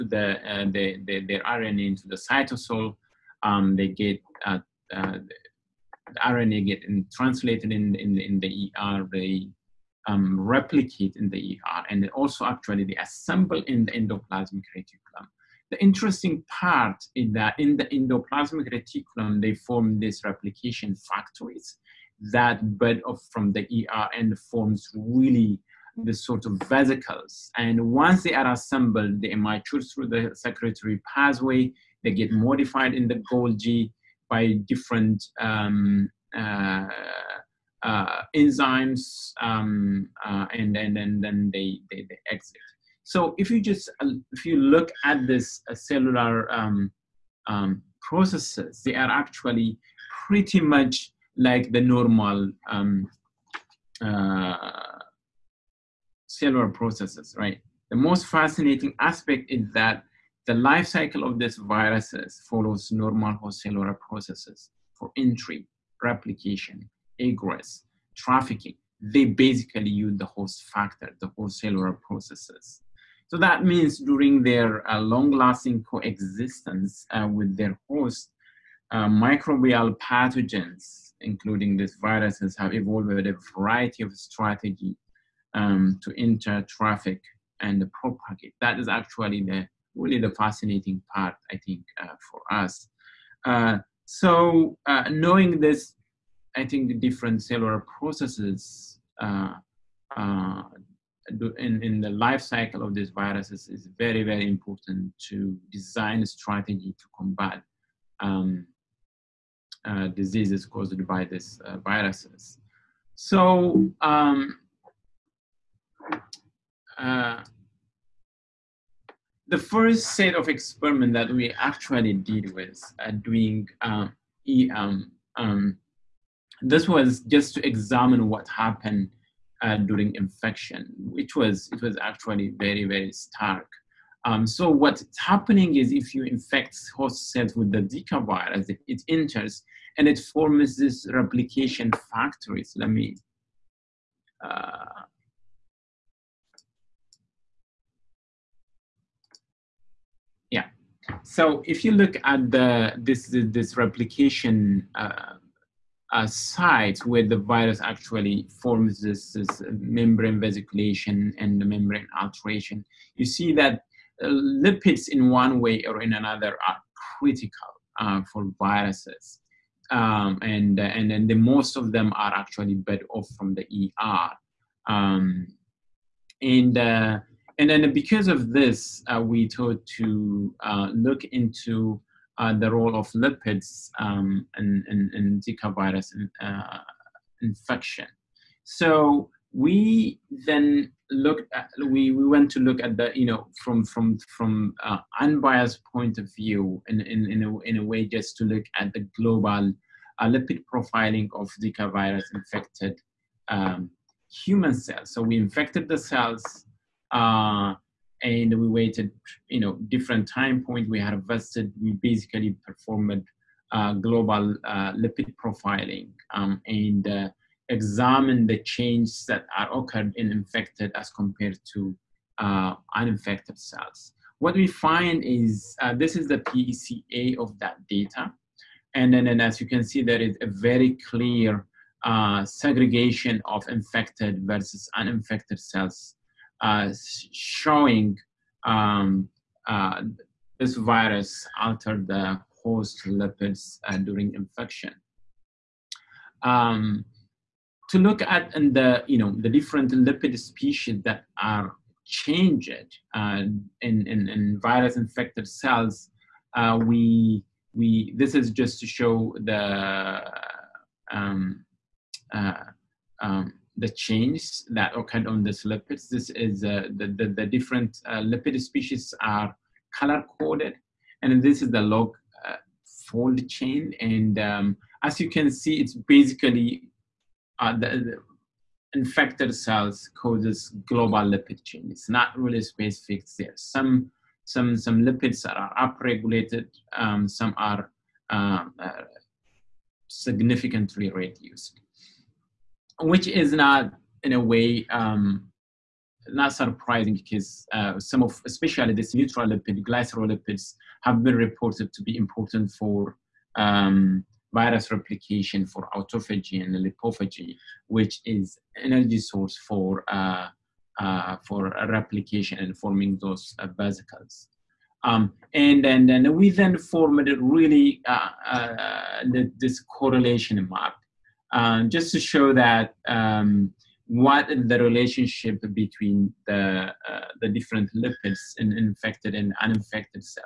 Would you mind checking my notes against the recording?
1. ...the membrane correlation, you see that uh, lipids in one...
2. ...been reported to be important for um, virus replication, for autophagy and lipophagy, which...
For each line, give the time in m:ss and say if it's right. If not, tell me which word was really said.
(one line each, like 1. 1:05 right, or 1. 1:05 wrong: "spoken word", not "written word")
1. 2:41 wrong: "alteration", not "correlation"
2. 5:01 right.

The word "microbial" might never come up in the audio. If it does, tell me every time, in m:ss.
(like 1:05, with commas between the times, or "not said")
1:19.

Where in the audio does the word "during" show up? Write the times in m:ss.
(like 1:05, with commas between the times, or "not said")
1:13, 2:09, 4:03.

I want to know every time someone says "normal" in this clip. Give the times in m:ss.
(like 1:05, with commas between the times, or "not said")
0:51, 1:02.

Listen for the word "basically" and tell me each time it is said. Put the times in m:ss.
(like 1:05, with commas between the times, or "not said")
1:09, 3:31, 4:35.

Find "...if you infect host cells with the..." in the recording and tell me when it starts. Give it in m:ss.
2:15.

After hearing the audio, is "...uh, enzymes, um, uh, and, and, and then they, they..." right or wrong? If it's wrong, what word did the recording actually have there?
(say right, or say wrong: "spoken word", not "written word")
right.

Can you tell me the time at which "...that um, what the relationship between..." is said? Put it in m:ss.
5:22.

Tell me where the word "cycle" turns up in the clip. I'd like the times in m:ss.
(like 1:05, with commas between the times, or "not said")
1:00, 1:42.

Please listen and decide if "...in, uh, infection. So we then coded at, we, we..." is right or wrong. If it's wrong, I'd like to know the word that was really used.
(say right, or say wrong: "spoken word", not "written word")
wrong: "looked", not "coded".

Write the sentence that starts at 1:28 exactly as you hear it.
That is actually the really the fascinating part, I think, uh, for us.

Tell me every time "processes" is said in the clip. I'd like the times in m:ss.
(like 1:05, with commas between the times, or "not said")
0:48, 0:56, 1:03, 1:11, 1:37.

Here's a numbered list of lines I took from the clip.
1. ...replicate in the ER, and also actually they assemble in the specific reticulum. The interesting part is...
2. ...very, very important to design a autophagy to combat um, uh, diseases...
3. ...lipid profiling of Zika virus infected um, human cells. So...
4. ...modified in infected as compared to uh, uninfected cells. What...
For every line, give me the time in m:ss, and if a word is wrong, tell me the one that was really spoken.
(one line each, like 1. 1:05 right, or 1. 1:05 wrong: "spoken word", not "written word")
1. 0:10 wrong: "endoplasmic", not "specific"
2. 1:43 wrong: "strategy", not "autophagy"
3. 3:20 right
4. 3:39 wrong: "occurred", not "modified".